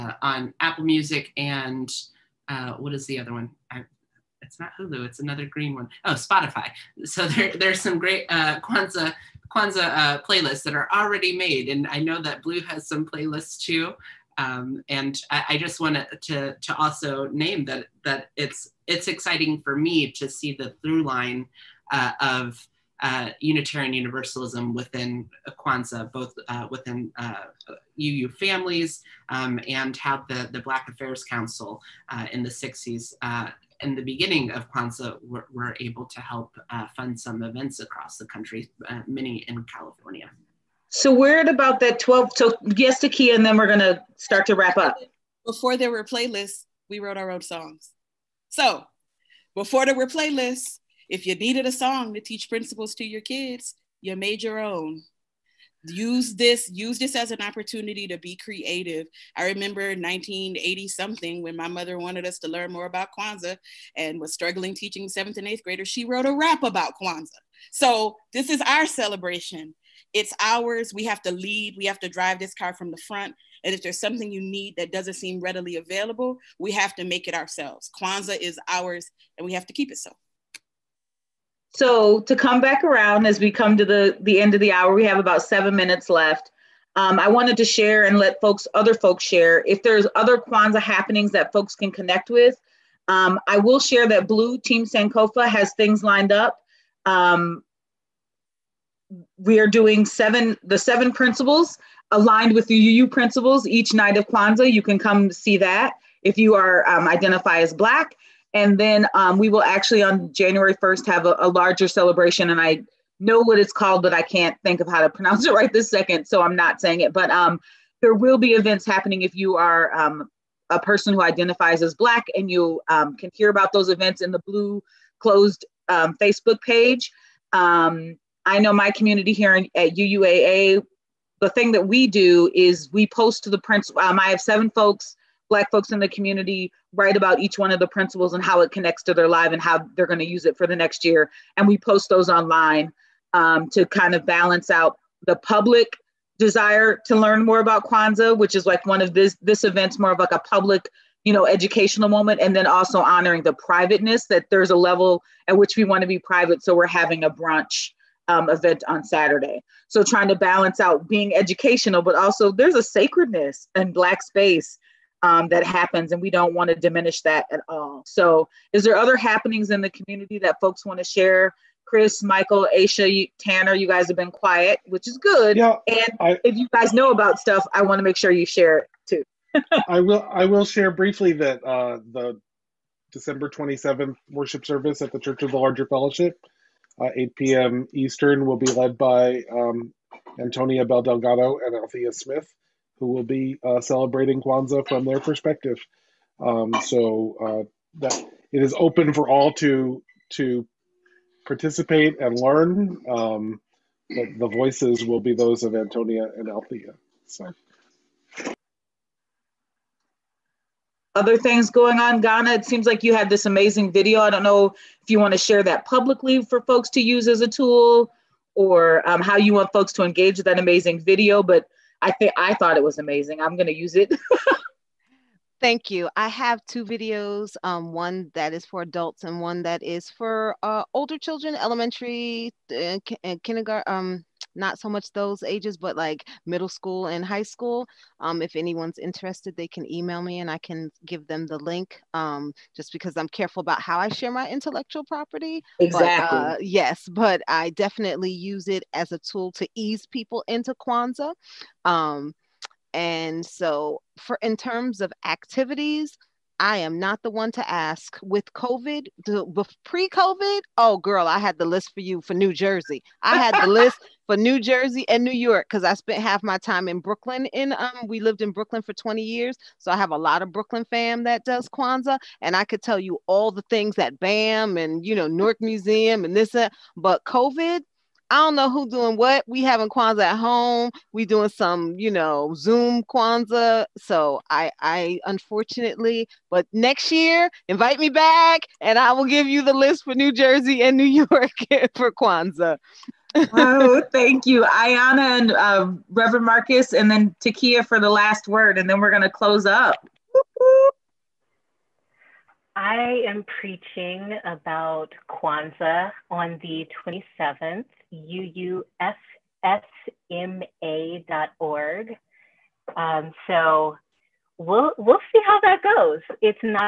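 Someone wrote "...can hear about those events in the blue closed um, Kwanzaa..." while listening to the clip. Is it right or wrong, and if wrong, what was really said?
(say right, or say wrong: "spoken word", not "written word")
wrong: "Facebook", not "Kwanzaa".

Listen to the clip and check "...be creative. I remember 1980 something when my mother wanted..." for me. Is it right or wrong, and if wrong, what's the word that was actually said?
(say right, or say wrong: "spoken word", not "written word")
right.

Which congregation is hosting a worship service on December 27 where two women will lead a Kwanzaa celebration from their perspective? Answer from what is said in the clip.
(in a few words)
Church of the Larger Fellowship.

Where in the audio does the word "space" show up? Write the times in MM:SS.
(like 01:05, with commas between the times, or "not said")
02:44.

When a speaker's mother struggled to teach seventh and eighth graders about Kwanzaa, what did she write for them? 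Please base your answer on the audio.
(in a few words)
a rap.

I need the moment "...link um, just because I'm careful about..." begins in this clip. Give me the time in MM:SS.
04:01.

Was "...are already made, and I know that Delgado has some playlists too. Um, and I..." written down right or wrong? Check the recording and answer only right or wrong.
wrong.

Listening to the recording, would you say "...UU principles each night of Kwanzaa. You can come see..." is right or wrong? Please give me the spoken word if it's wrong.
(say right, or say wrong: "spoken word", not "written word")
right.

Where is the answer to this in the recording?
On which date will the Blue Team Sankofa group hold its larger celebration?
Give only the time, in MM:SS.
01:50.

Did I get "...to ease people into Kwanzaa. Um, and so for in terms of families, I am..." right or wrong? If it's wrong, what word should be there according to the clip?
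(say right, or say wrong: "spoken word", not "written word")
wrong: "activities", not "families".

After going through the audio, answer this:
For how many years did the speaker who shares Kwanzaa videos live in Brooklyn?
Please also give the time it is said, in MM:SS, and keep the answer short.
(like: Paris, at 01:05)
20, at 04:28.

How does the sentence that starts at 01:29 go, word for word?
If there's other Kwanzaa happenings that folks can connect with, um, I will share that Blue Team Sankofa has things lined up.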